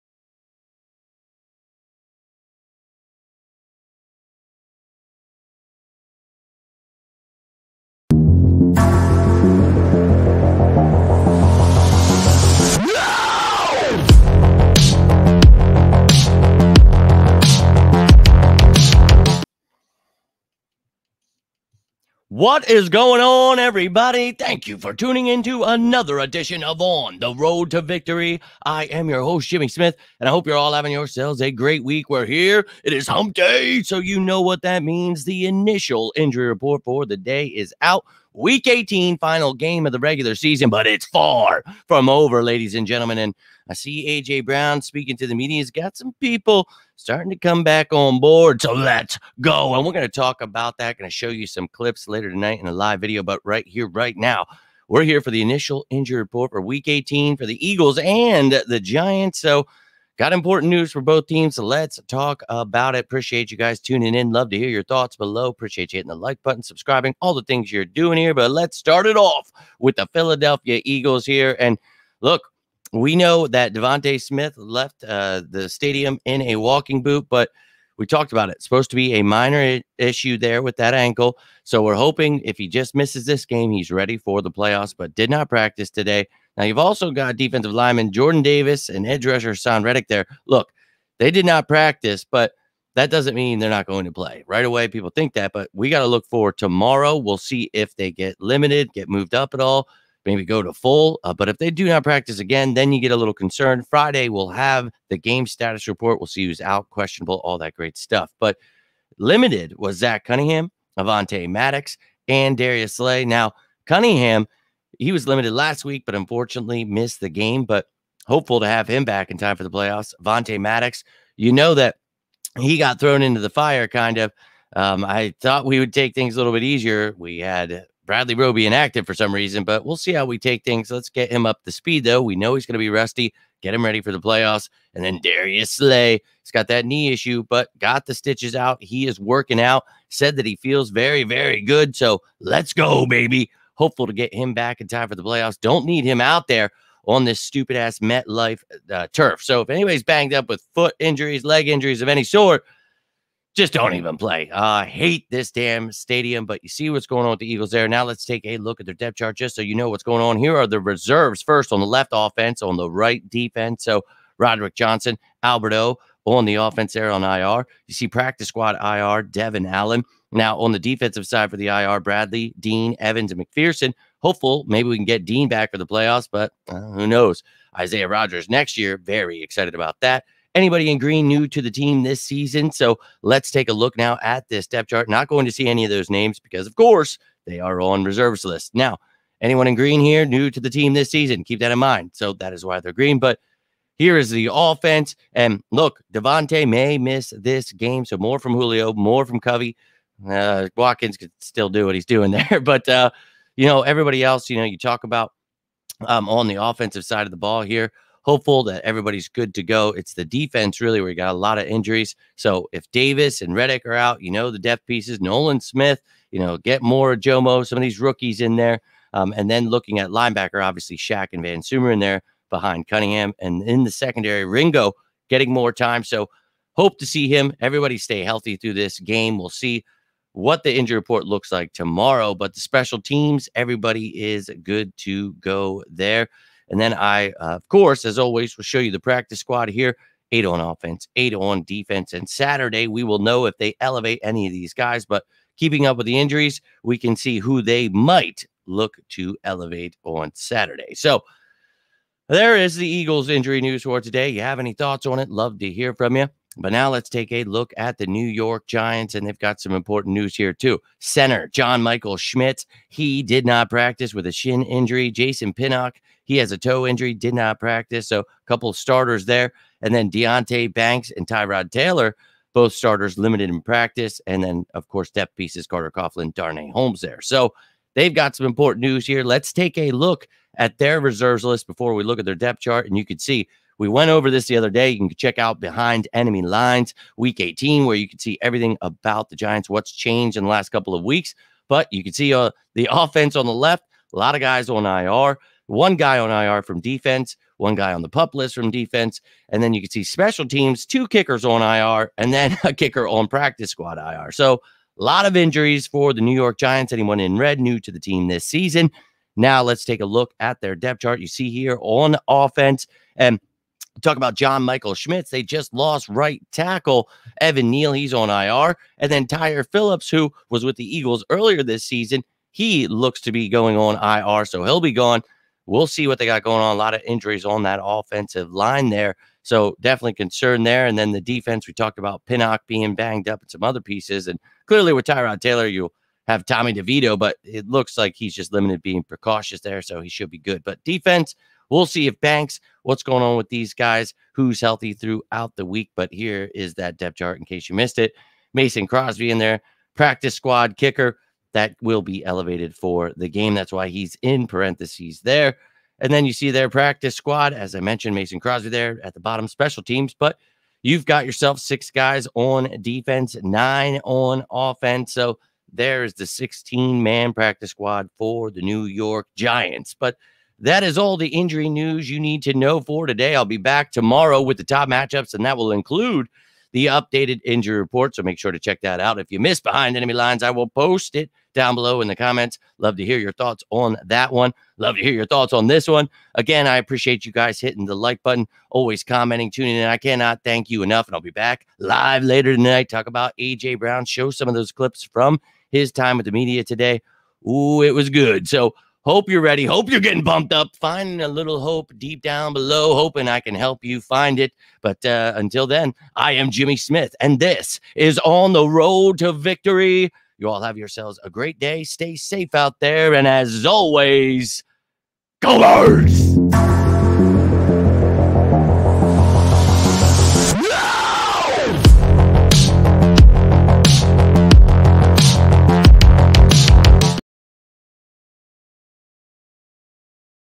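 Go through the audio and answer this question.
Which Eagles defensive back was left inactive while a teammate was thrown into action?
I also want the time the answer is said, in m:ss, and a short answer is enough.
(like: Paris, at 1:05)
Bradley Roby, at 2:08.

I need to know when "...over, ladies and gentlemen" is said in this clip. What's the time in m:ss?
0:42.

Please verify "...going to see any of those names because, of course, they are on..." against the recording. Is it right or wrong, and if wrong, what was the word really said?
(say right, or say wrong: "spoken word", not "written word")
right.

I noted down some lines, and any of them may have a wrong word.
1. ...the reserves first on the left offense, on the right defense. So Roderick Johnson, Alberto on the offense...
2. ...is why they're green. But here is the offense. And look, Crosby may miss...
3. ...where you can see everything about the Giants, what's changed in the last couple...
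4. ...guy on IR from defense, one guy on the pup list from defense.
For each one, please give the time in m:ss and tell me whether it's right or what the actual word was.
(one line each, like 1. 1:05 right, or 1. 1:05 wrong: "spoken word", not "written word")
1. 2:40 right
2. 3:12 wrong: "DeVonta", not "Crosby"
3. 4:47 right
4. 4:55 right.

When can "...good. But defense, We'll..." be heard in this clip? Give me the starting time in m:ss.
5:40.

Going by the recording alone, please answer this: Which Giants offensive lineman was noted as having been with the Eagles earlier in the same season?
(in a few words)
Tyre Phillips.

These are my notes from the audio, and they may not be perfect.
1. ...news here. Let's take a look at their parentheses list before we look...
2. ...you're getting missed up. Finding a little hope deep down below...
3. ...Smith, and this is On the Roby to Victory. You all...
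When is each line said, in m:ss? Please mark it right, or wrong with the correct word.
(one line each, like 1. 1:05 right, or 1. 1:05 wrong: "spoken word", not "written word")
1. 4:38 wrong: "reserves", not "parentheses"
2. 6:39 wrong: "bumped", not "missed"
3. 6:46 wrong: "Road", not "Roby".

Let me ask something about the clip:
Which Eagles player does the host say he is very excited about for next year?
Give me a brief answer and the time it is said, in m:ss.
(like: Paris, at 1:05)
Isaiah Rogers, at 2:57.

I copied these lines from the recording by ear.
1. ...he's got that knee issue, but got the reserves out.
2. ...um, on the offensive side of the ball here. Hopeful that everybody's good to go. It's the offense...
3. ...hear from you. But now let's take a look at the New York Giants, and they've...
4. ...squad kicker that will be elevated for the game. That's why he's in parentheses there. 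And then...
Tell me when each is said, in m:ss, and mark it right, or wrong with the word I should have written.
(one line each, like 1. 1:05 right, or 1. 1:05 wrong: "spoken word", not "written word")
1. 2:16 wrong: "stitches", not "reserves"
2. 3:26 wrong: "defense", not "offense"
3. 4:15 right
4. 5:50 right.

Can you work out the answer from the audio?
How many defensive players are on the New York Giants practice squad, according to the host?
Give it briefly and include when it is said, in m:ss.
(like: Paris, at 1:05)
6, at 6:01.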